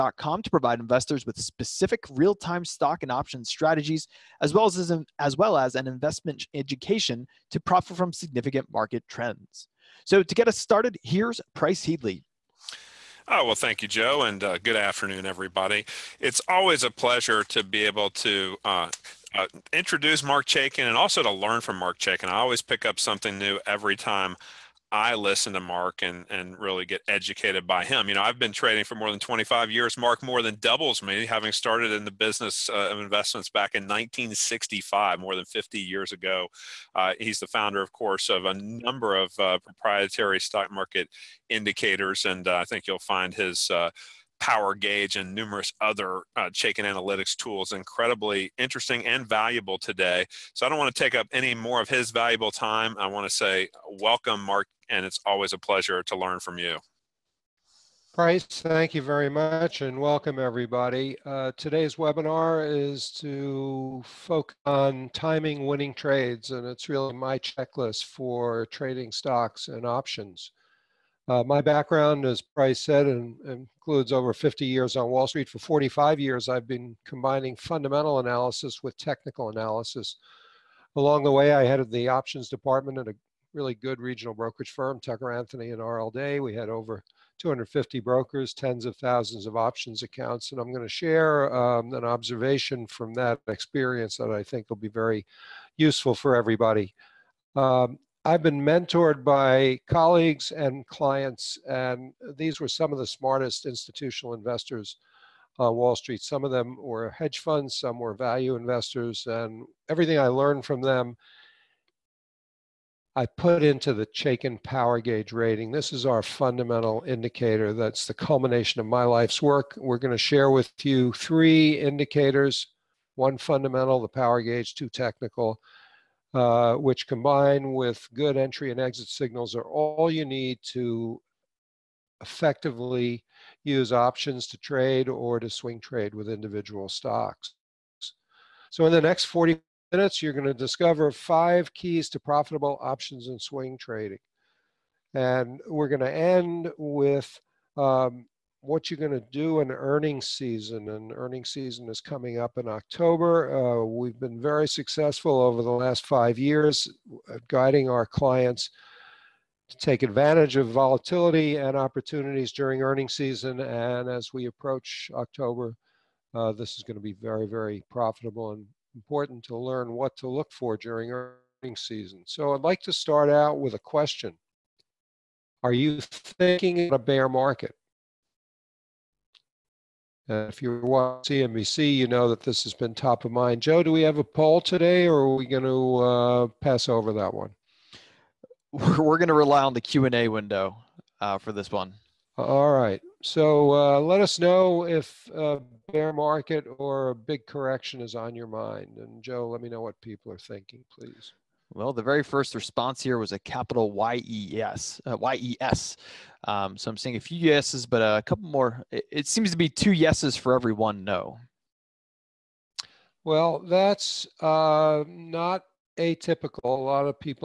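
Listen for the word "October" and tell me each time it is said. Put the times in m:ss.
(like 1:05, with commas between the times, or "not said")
2:32, 2:45.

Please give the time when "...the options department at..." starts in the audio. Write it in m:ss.
1:21.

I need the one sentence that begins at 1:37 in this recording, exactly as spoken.
Um, I've been mentored by colleagues and clients, and these were some of the smartest institutional investors on Wall Street.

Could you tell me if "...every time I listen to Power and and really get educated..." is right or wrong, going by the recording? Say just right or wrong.
wrong.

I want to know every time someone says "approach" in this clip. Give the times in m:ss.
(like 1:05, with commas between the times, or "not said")
2:44.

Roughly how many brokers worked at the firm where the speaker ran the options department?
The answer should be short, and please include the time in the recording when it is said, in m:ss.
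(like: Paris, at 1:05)
over 250, at 1:26.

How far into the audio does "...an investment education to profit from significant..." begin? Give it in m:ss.
0:05.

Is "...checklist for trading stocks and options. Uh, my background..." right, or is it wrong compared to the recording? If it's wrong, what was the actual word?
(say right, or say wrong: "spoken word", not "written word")
right.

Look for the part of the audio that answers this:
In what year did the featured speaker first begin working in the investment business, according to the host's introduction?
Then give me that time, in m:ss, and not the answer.
0:33.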